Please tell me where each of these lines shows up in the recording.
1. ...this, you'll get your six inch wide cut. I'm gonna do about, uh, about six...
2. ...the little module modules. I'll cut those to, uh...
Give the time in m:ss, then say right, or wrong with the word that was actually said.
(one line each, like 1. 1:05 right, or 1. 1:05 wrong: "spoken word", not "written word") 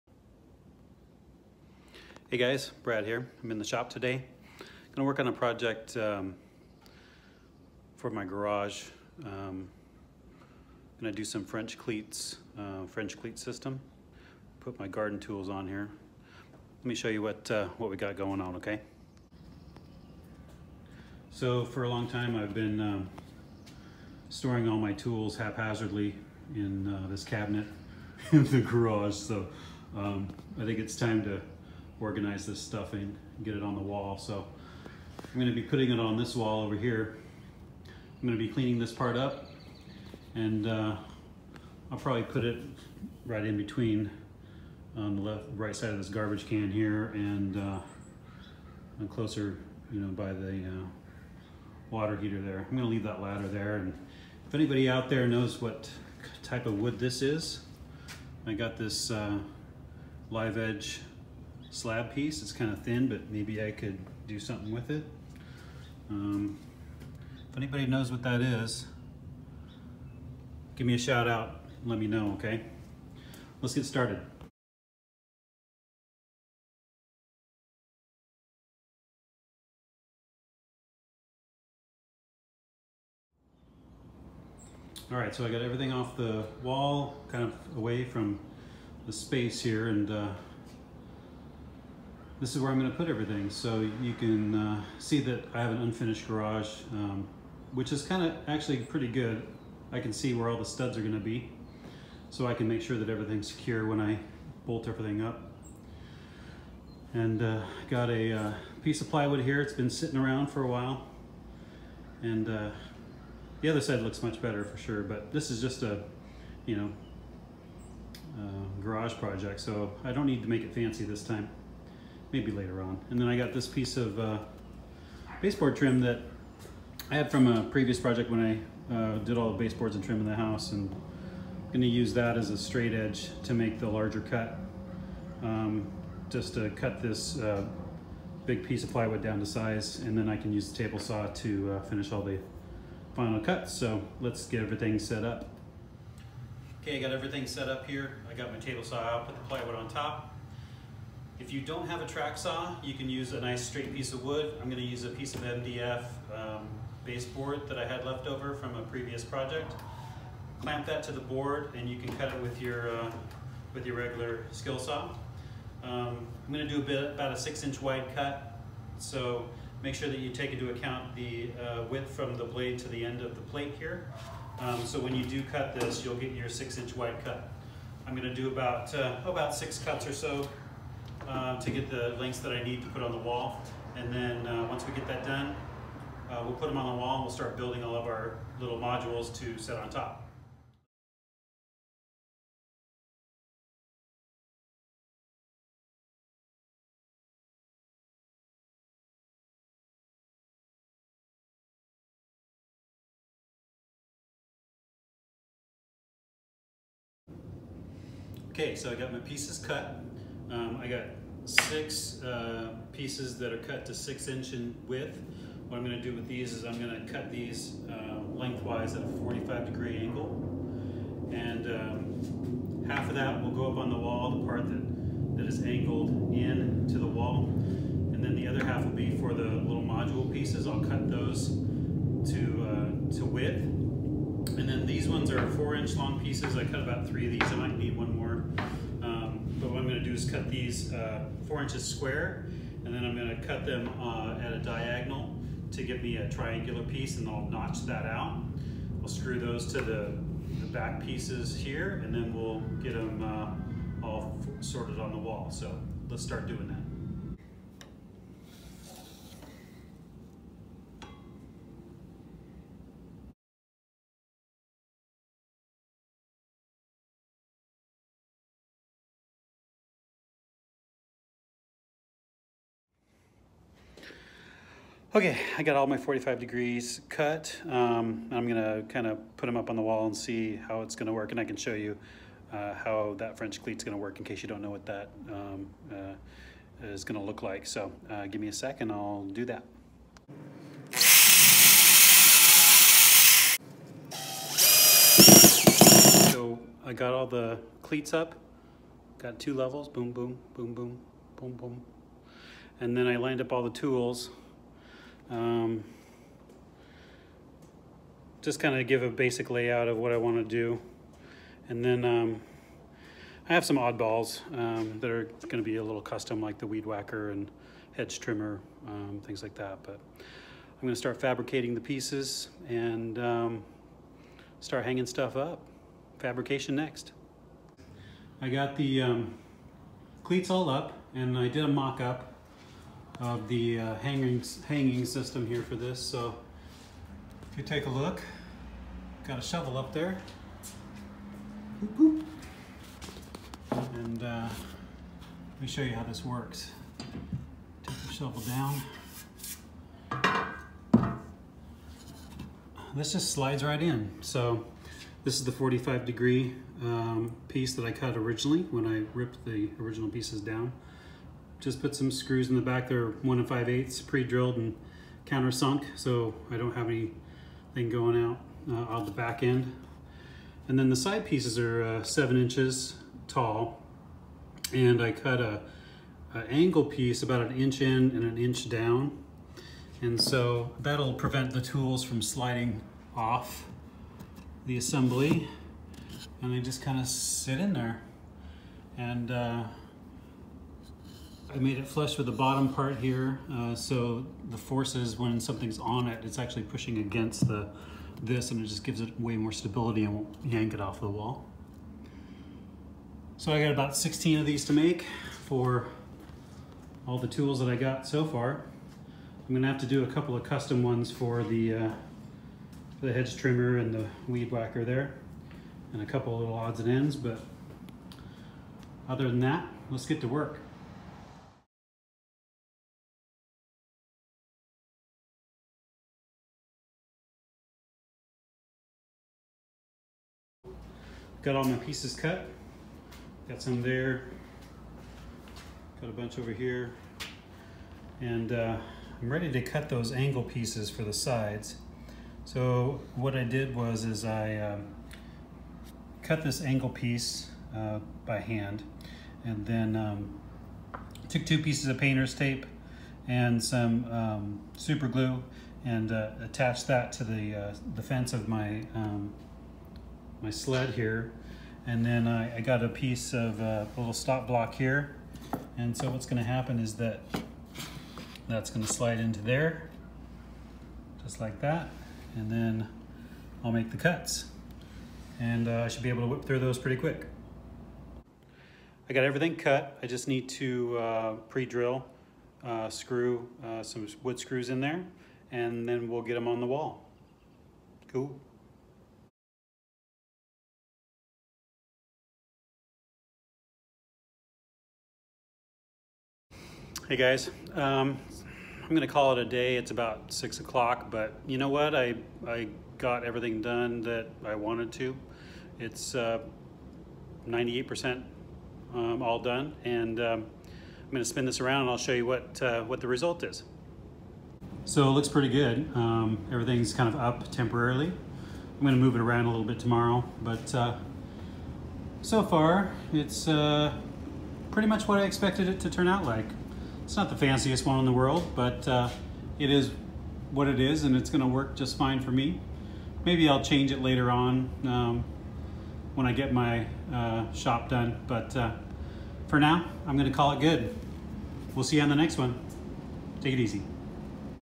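1. 2:55 right
2. 3:49 wrong: "pieces", not "modules".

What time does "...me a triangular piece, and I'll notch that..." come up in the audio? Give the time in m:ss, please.
4:06.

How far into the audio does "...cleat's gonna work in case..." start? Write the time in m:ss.
4:43.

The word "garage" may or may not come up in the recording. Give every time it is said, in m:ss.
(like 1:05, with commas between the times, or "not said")
0:08, 0:28, 1:36, 1:58.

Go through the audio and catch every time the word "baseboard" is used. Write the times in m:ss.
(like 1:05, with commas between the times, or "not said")
2:05, 2:09, 2:37.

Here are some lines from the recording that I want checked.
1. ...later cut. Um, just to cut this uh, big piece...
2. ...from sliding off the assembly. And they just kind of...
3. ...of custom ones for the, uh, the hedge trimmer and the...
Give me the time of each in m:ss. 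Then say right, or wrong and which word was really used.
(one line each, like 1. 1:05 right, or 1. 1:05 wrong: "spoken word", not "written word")
1. 2:13 wrong: "larger", not "later"
2. 6:22 right
3. 6:50 right.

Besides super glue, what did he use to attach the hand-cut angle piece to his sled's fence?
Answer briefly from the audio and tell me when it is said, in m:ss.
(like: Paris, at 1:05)
painter's tape, at 7:31.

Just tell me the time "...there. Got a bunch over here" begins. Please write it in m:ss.
7:13.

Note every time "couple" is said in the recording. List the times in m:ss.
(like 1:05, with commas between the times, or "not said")
6:50, 6:56.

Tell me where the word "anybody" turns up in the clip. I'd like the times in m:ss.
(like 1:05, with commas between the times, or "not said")
0:54, 1:07.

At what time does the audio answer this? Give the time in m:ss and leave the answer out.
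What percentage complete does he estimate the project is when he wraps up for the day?
8:26.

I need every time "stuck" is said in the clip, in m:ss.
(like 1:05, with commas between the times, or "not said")
not said.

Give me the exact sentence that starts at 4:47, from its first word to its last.
So uh, give me a second, I'll do that.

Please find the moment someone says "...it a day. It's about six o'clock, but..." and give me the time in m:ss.
8:19.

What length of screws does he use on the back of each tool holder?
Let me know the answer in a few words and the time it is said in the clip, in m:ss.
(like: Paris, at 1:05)
1 5/8 inches, at 6:03.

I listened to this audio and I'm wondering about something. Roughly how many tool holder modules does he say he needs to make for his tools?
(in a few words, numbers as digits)
16.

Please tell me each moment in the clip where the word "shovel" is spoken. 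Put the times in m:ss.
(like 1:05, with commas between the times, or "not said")
5:39, 5:48.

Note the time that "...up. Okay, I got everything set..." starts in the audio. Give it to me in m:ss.
2:25.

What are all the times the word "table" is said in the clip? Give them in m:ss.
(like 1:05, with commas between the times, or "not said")
2:20, 2:28.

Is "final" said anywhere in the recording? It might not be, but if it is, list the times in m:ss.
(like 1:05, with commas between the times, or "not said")
2:23.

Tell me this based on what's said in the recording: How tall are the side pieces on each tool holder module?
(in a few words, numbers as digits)
7 inches.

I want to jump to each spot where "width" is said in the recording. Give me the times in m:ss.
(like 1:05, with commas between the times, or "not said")
2:51, 3:34, 3:53.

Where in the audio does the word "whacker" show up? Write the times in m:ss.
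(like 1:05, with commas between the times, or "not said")
5:16, 6:54.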